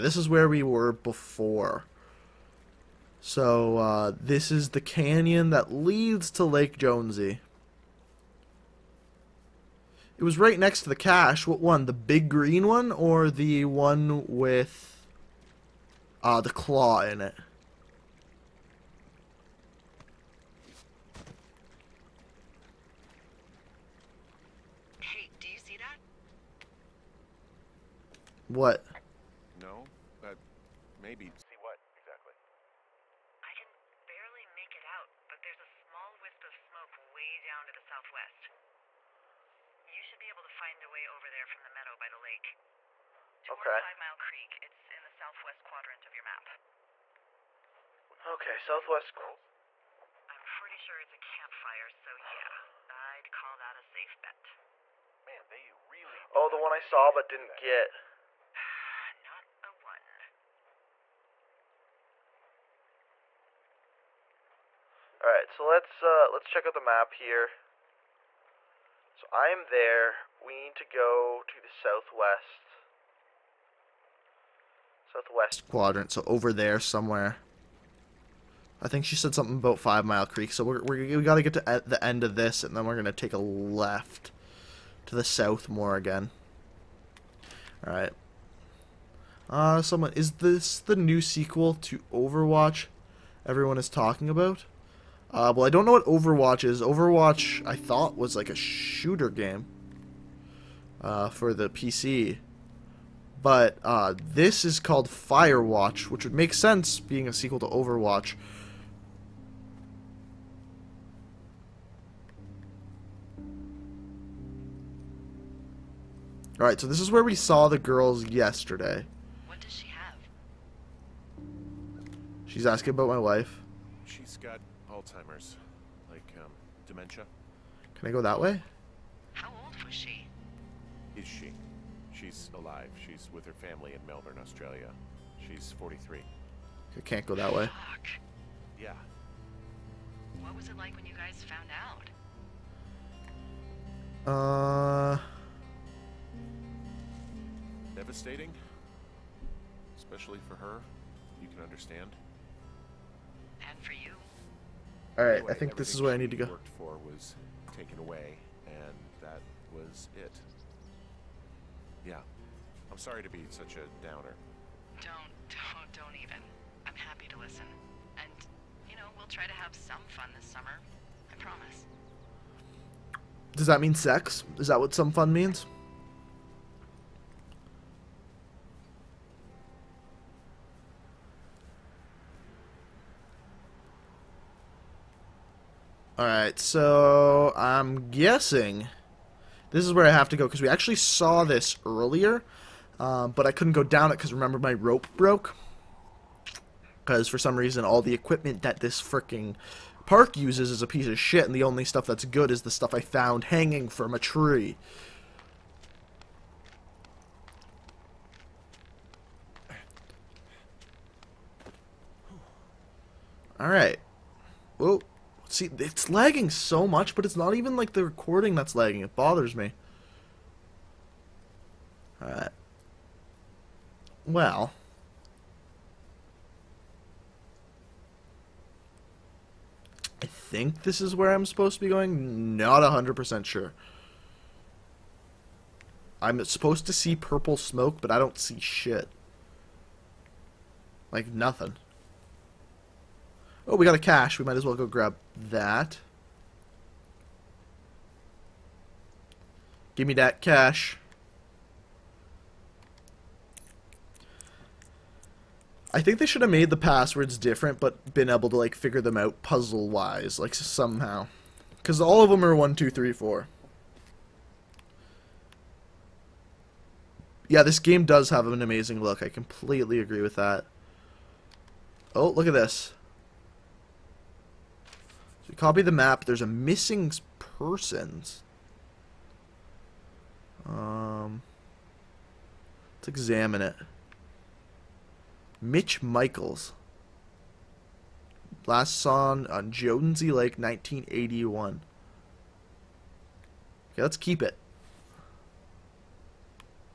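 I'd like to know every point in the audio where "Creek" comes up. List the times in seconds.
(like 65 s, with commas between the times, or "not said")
44 s, 80 s.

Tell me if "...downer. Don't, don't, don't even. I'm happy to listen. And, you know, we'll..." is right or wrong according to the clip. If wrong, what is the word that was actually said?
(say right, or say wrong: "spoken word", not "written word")
right.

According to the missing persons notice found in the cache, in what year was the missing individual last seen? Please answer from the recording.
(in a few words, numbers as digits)
1981.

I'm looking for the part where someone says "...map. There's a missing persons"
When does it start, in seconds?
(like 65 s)
275 s.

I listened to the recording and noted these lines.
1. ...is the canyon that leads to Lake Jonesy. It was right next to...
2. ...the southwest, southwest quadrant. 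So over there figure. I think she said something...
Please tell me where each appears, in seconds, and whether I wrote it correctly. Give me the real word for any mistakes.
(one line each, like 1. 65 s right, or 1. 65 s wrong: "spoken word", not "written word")
1. 4 s right
2. 71 s wrong: "somewhere", not "figure".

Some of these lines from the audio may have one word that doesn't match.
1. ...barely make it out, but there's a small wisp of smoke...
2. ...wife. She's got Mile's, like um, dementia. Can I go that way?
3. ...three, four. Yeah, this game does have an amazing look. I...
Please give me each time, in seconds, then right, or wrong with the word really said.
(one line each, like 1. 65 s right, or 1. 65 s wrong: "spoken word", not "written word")
1. 34 s right
2. 123 s wrong: "Alzheimer", not "Mile"
3. 262 s right.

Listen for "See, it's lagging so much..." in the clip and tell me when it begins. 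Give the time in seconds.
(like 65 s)
215 s.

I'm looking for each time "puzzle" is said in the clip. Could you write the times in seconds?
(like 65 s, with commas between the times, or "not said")
259 s.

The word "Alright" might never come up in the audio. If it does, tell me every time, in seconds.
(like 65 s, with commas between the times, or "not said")
116 s, 155 s, 186 s, 213 s, 222 s.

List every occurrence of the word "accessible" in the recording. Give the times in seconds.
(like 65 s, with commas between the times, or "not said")
not said.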